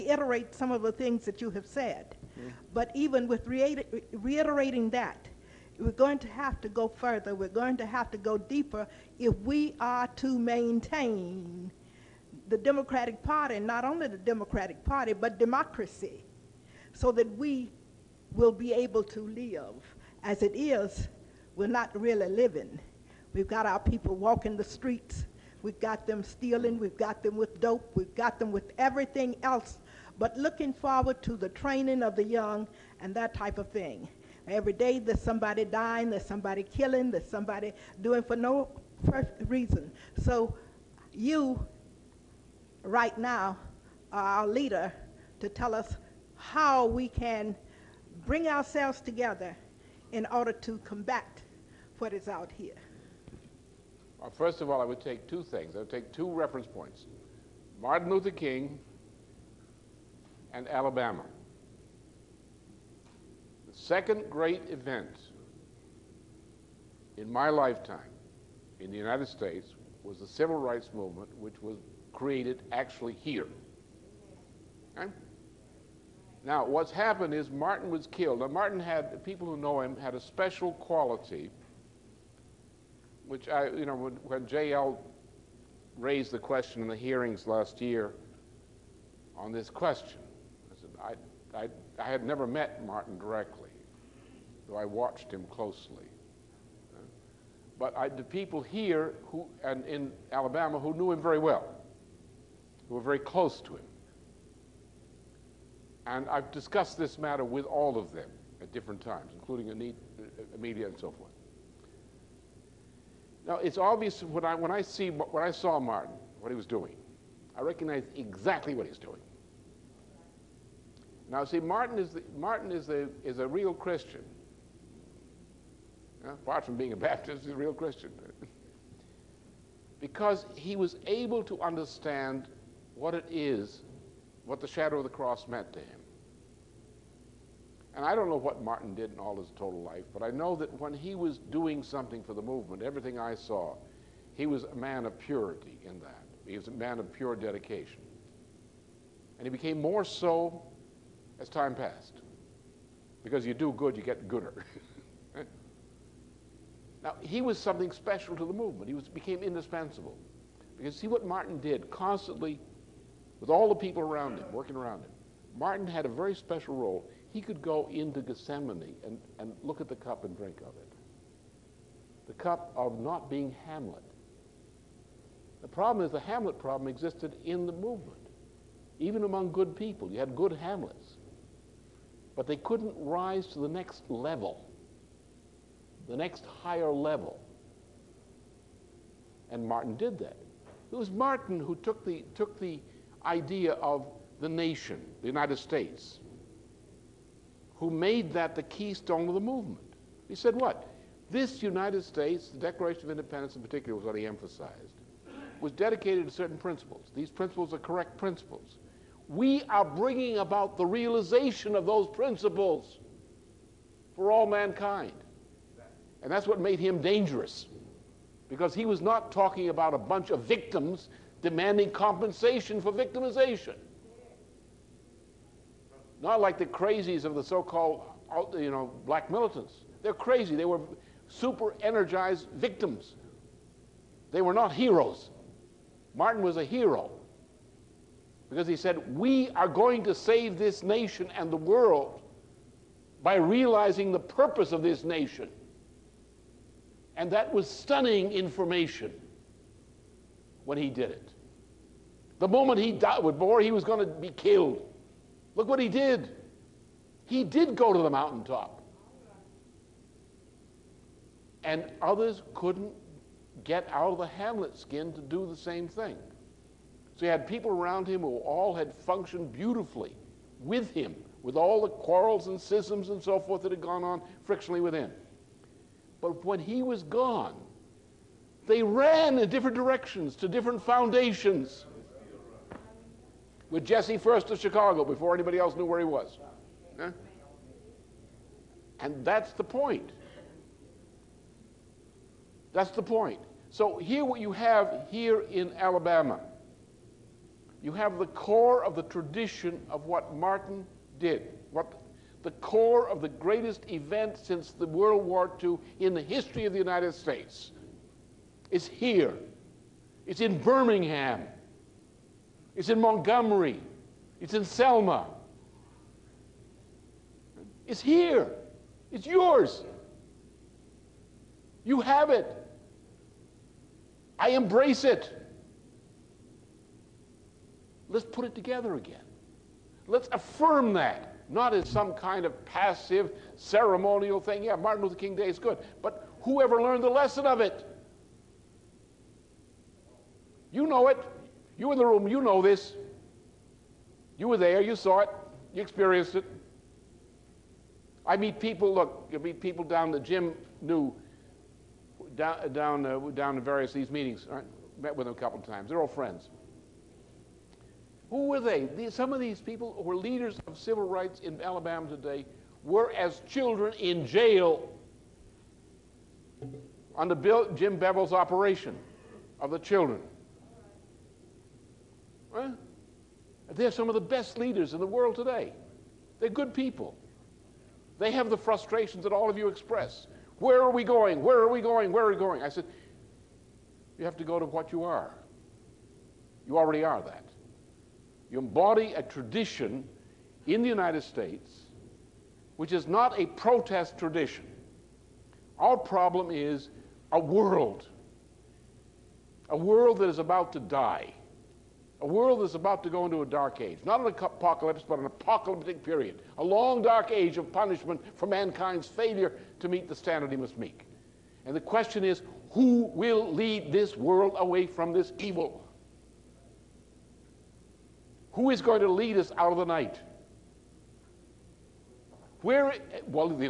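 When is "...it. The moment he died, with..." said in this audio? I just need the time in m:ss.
4:11.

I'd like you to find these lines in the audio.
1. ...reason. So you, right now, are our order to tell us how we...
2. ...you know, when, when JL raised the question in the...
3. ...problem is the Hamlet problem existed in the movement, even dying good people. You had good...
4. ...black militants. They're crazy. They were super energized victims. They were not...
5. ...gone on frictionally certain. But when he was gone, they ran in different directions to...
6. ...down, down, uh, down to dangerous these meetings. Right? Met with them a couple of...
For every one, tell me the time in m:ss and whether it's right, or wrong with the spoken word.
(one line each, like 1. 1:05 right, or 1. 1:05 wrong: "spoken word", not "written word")
1. 0:39 wrong: "leader", not "order"
2. 1:23 right
3. 2:55 wrong: "among", not "dying"
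4. 3:49 right
5. 4:33 wrong: "within", not "certain"
6. 5:52 wrong: "various", not "dangerous".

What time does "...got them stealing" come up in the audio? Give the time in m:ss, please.
0:25.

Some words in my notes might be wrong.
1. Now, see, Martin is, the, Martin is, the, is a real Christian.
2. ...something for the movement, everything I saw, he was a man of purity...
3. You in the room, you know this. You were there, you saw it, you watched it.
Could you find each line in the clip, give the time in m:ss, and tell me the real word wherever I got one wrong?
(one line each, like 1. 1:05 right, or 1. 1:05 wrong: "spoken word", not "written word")
1. 2:01 right
2. 2:21 right
3. 5:41 wrong: "experienced", not "watched".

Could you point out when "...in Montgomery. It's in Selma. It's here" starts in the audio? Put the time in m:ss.
5:12.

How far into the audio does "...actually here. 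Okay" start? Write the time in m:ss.
1:12.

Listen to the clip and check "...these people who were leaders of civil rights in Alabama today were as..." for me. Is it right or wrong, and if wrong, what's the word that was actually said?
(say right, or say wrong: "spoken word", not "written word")
right.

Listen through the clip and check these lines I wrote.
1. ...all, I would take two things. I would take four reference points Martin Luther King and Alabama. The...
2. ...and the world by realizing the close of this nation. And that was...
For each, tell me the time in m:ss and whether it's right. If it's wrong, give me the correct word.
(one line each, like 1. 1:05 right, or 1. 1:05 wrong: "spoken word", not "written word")
1. 0:54 wrong: "two", not "four"
2. 4:01 wrong: "purpose", not "close".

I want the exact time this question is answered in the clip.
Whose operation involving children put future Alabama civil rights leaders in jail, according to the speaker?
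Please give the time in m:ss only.
6:07.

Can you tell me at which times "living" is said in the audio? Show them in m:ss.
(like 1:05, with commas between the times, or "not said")
0:22.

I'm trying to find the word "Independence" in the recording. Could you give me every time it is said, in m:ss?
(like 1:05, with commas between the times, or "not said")
3:23.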